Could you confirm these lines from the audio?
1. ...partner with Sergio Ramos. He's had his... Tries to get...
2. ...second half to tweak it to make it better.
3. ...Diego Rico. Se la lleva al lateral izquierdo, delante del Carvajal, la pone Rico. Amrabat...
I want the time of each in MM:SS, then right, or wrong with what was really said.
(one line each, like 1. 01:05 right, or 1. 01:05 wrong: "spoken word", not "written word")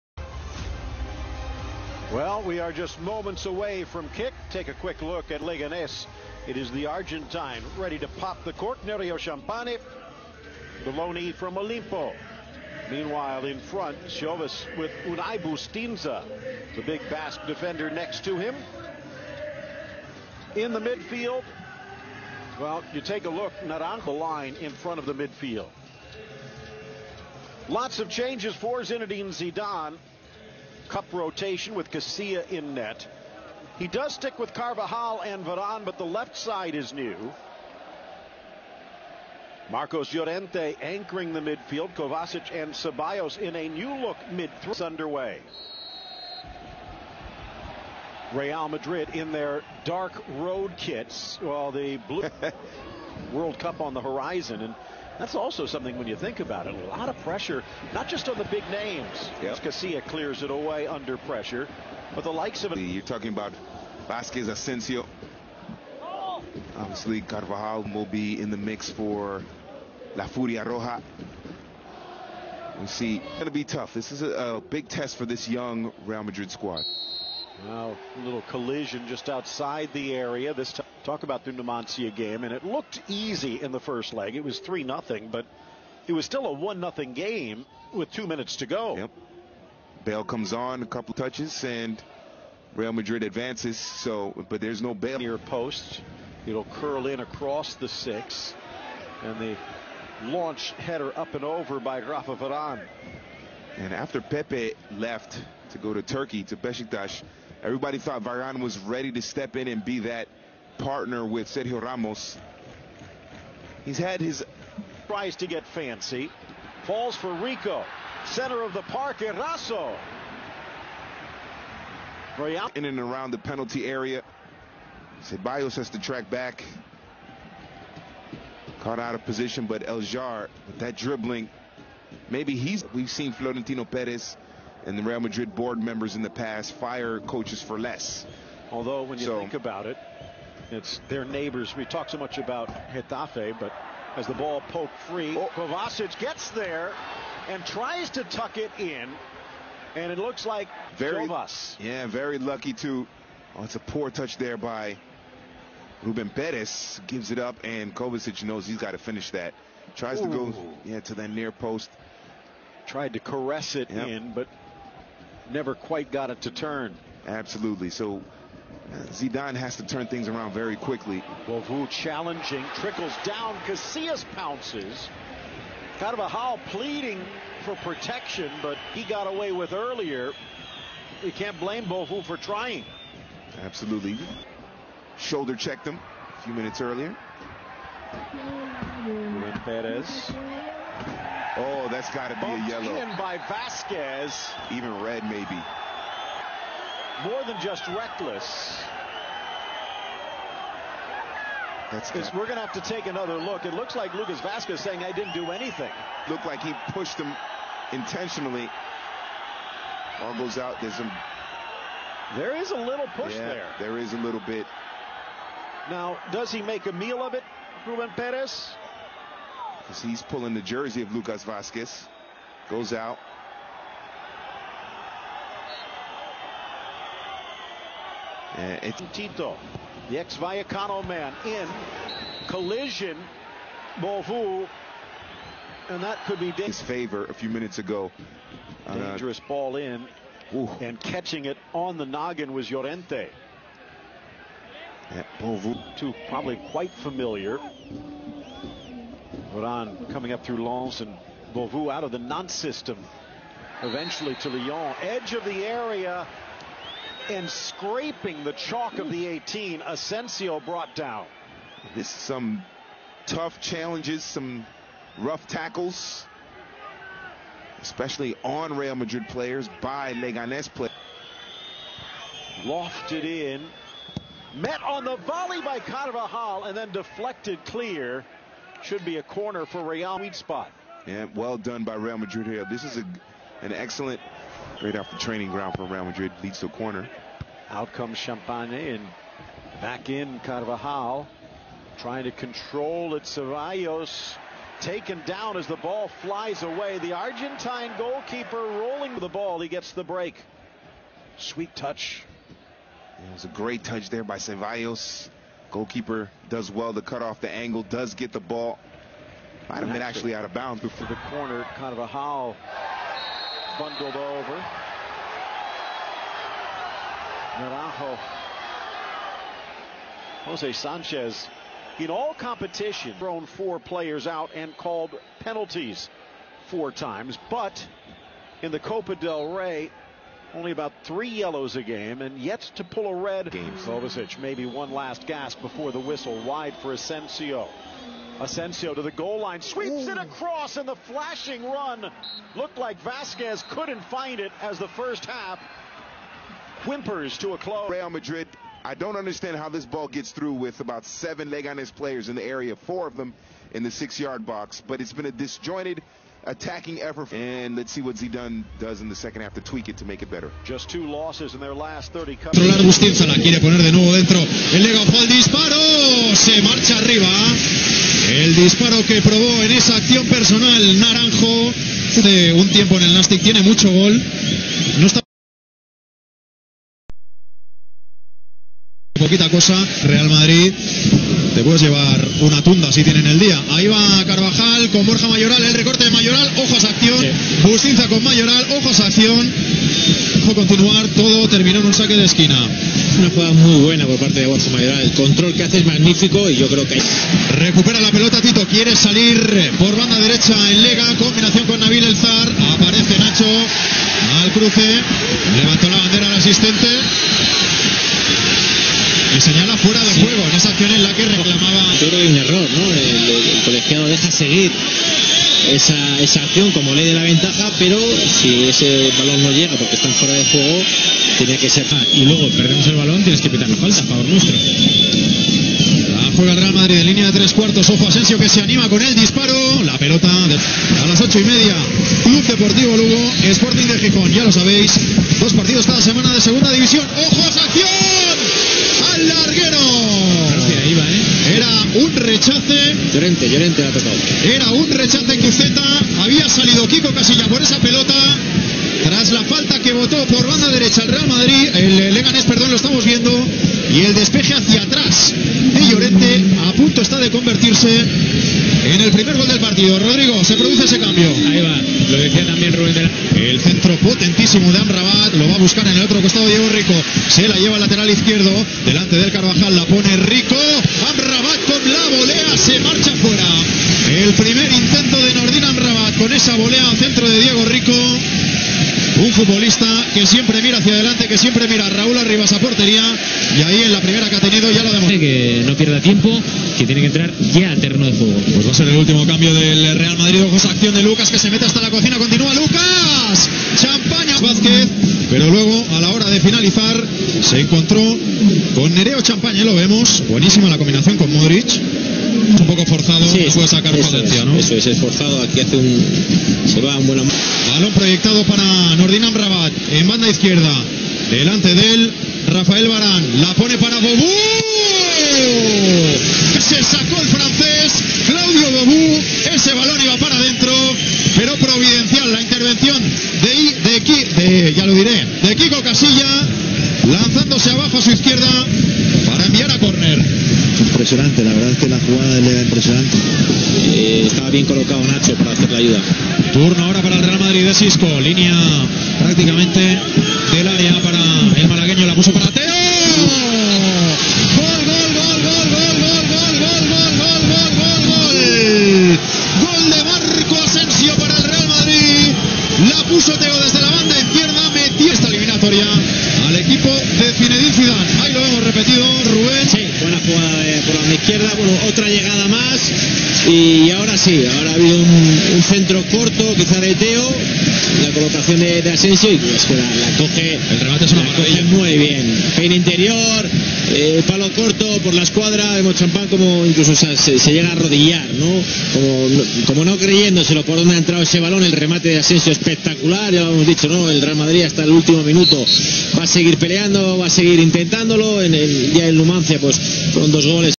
1. 01:50 right
2. 05:59 right
3. 07:46 right.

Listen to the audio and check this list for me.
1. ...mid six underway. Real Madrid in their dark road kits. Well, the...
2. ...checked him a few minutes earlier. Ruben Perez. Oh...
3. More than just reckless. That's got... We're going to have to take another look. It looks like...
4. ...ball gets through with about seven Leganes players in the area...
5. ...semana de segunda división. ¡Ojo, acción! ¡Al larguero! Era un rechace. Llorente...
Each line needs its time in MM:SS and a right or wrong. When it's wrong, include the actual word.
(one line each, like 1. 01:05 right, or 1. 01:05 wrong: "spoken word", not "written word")
1. 00:44 wrong: "three", not "six"
2. 03:05 right
3. 03:17 right
4. 05:49 right
5. 07:16 right.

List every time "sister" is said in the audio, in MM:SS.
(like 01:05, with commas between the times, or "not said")
not said.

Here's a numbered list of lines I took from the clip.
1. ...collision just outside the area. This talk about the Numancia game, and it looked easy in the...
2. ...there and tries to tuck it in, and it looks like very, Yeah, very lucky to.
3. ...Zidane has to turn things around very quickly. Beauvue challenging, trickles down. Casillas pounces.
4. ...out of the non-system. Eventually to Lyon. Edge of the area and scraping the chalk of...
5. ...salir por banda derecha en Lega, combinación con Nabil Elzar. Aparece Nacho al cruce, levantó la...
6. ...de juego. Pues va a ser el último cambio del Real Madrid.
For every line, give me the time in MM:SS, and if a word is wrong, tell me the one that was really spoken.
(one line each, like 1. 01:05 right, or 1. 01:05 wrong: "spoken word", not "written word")
1. 01:18 right
2. 02:26 right
3. 02:49 right
4. 04:11 right
5. 06:38 right
6. 08:07 right.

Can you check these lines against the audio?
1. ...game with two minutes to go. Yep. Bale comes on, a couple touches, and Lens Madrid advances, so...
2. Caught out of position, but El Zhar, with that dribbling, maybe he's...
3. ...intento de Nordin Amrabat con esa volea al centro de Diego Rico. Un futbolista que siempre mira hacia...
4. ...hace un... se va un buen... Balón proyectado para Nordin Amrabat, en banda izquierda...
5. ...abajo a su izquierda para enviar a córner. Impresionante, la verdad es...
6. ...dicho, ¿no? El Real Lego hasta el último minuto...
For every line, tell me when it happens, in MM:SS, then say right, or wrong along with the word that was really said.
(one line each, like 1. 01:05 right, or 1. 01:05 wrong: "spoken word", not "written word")
1. 01:27 wrong: "Real", not "Lens"
2. 02:08 right
3. 07:54 right
4. 08:25 right
5. 08:47 right
6. 09:43 wrong: "Madrid", not "Lego".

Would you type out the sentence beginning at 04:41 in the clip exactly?
Yeah, well done by Real Madrid here.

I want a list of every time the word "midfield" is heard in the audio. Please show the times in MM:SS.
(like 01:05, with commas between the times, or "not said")
00:20, 00:25, 00:41.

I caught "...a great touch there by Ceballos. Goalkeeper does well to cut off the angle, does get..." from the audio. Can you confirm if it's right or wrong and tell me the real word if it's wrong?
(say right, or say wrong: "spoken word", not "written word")
right.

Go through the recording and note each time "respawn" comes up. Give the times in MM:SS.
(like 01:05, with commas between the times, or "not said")
not said.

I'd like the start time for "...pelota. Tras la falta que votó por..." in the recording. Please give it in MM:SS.
07:27.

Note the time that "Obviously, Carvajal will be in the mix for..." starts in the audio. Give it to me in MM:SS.
01:06.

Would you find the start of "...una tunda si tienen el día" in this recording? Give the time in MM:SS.
06:22.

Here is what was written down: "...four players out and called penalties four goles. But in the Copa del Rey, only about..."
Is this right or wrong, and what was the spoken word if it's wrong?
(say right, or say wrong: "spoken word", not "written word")
wrong: "times", not "goles".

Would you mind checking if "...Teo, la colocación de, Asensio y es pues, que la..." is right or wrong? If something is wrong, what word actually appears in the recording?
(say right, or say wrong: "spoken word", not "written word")
right.